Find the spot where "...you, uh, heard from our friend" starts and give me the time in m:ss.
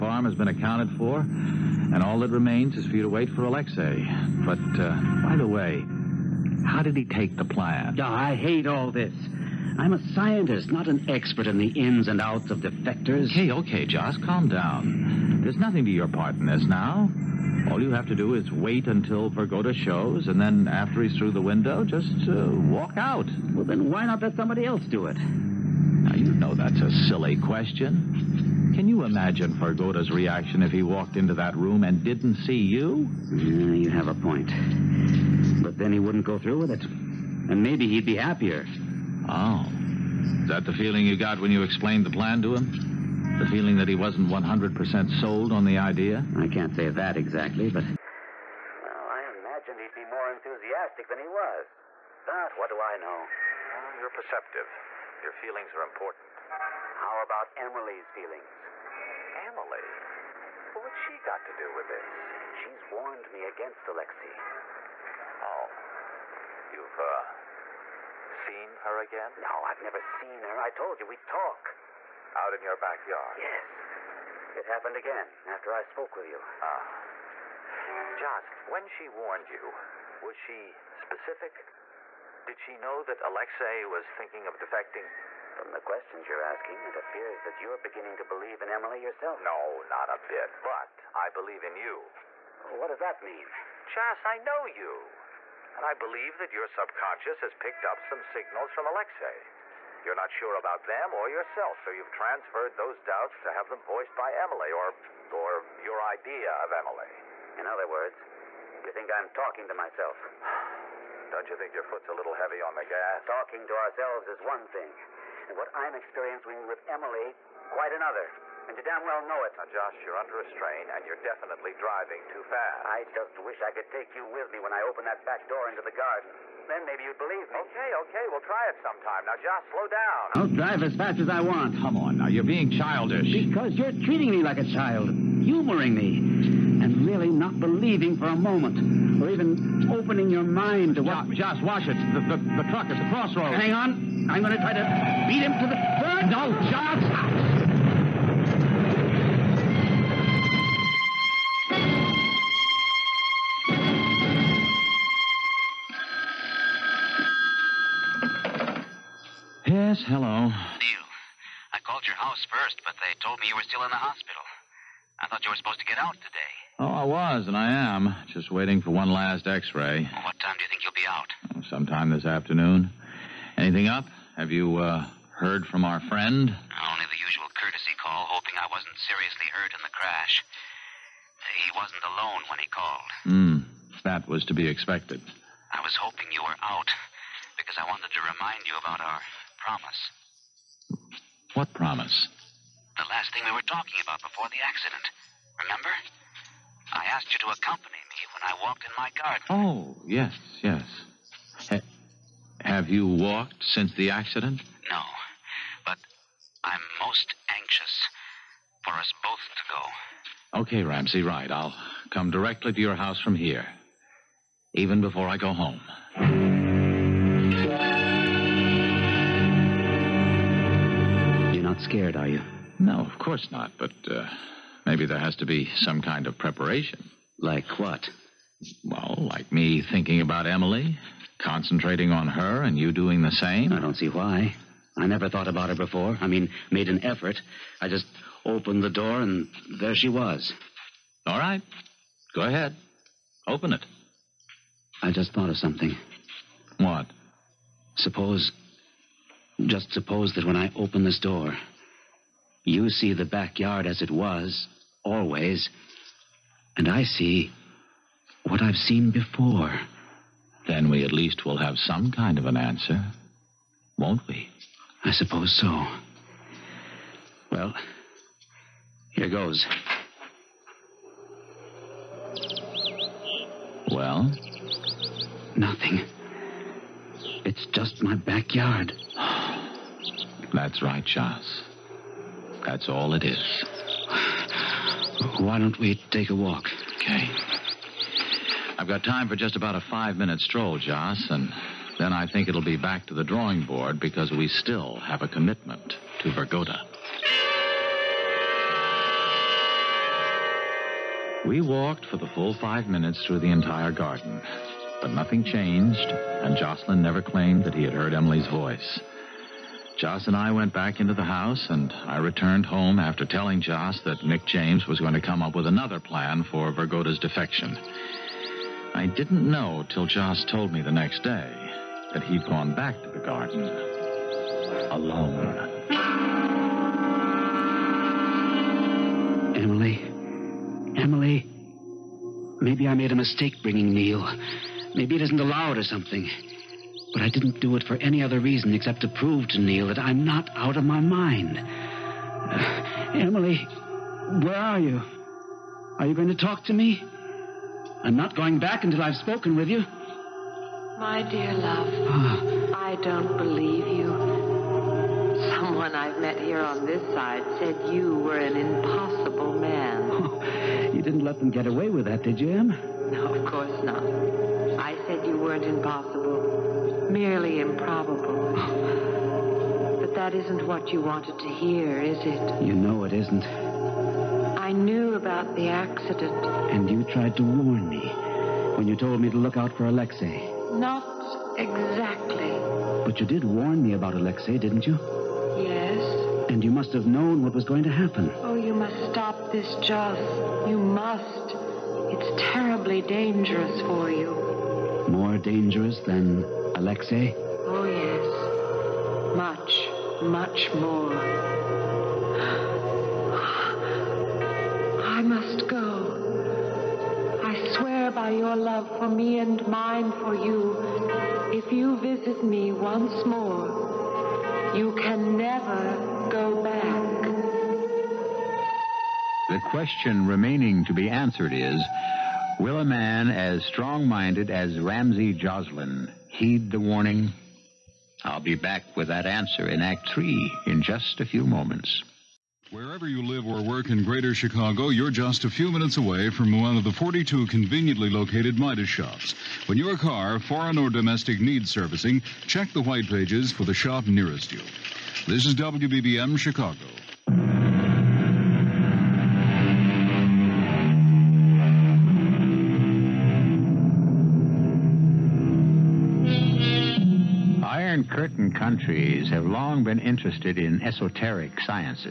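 2:54.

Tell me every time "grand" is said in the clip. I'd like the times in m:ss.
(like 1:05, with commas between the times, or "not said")
not said.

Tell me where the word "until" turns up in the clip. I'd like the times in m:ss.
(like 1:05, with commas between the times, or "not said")
0:18, 5:48.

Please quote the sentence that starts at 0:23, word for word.
Well, then why not let somebody else do it?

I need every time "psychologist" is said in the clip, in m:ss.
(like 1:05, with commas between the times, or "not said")
not said.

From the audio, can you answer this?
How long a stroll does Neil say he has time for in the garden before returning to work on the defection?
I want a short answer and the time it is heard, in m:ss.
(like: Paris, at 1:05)
5 minutes, at 4:49.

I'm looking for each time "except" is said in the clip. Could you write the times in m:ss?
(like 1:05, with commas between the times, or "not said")
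5:38.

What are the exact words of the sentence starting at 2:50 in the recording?
Well, what time do you think you'll be out?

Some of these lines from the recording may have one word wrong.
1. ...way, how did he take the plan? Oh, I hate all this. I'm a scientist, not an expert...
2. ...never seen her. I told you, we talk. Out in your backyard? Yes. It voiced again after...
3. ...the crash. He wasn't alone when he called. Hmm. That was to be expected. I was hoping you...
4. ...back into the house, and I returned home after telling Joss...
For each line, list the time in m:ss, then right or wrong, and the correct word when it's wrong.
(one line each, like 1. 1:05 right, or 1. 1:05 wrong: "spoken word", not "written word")
1. 0:05 right
2. 1:09 wrong: "happened", not "voiced"
3. 2:59 right
4. 5:10 right.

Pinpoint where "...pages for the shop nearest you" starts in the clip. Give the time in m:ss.
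7:23.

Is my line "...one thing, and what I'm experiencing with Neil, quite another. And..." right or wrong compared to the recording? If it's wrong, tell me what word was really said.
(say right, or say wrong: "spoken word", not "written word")
wrong: "Emily", not "Neil".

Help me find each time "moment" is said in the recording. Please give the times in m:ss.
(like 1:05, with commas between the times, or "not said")
2:18, 7:11.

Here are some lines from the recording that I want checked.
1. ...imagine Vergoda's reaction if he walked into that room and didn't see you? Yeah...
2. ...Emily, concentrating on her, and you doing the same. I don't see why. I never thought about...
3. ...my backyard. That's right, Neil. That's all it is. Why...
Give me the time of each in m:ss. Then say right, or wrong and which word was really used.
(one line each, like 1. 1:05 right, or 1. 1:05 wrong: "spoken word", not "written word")
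1. 0:29 right
2. 3:50 right
3. 4:38 wrong: "Charles", not "Neil".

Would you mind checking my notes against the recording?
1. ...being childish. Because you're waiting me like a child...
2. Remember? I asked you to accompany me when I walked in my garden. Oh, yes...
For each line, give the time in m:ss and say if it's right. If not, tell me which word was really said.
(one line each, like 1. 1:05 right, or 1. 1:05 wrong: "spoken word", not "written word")
1. 2:12 wrong: "treating", not "waiting"
2. 3:15 right.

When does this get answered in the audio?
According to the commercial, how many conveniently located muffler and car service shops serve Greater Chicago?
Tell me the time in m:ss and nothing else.
7:16.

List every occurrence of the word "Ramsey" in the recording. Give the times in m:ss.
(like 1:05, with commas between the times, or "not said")
3:30, 7:04.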